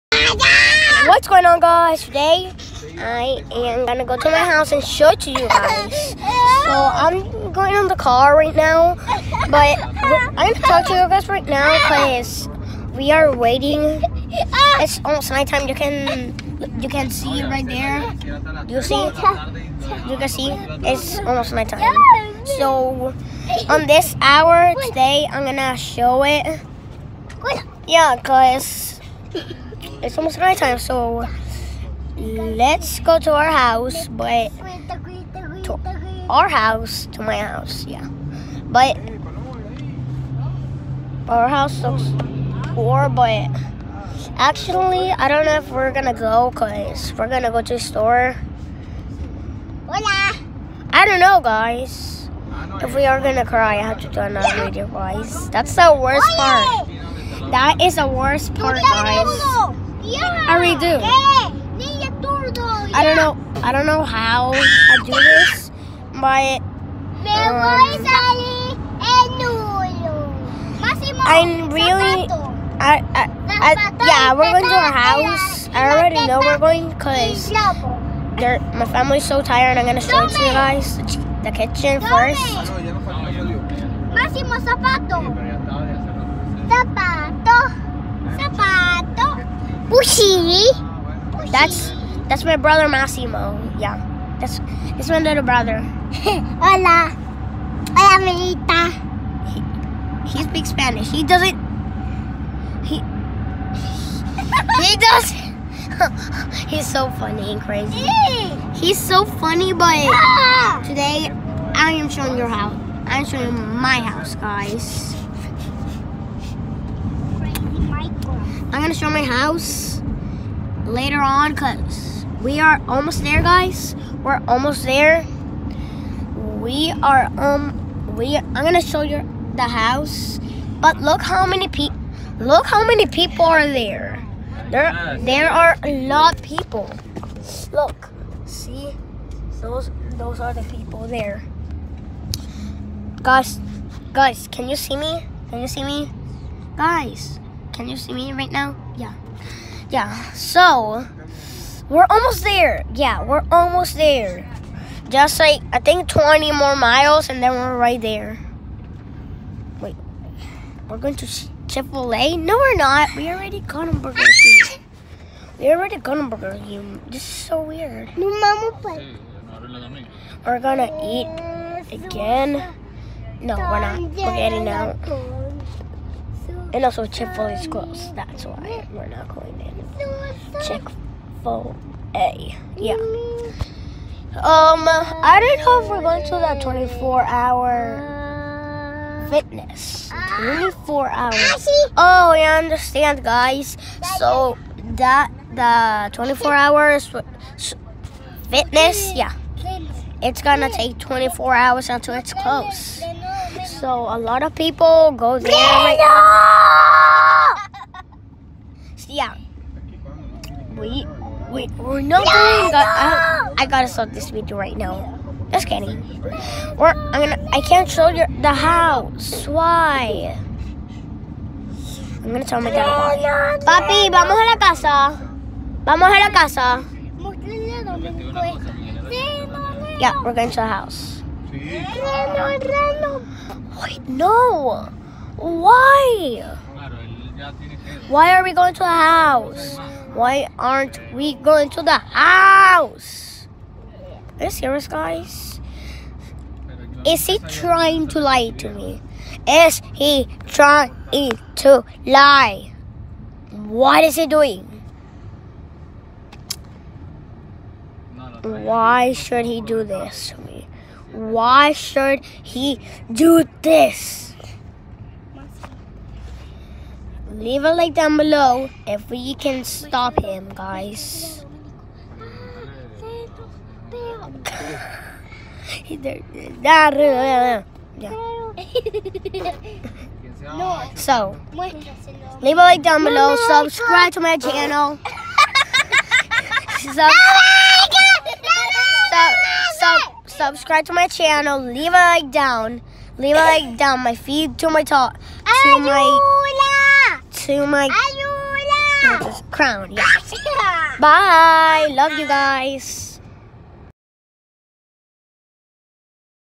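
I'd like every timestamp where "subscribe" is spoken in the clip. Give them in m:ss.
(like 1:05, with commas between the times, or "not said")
4:43, 4:50.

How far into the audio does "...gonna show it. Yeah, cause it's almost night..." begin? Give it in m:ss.
0:25.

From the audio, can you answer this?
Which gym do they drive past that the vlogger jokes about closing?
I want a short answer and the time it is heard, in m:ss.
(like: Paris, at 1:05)
24 Hour Fitness, at 3:06.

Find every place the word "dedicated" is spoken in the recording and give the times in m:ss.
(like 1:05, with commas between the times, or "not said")
not said.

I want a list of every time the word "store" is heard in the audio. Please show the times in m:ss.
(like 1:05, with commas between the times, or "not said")
0:47.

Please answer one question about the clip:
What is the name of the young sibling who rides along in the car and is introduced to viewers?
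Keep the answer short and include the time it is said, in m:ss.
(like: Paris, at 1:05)
Massimo, at 1:32.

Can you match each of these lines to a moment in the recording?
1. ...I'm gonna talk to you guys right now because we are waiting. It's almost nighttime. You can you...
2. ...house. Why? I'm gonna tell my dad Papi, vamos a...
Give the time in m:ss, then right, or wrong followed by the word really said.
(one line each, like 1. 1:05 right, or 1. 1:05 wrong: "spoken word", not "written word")
1. 0:09 right
2. 3:38 right.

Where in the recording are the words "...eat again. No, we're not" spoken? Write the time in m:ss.
2:51.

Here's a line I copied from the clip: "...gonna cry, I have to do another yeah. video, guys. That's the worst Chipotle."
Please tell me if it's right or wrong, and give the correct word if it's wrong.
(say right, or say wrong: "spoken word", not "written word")
wrong: "Oye", not "Chipotle".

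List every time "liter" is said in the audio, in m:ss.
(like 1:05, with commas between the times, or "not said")
not said.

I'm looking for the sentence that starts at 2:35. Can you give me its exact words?
Just like, I think 20 more miles and then we're right there.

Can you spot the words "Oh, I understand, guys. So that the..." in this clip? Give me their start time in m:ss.
3:11.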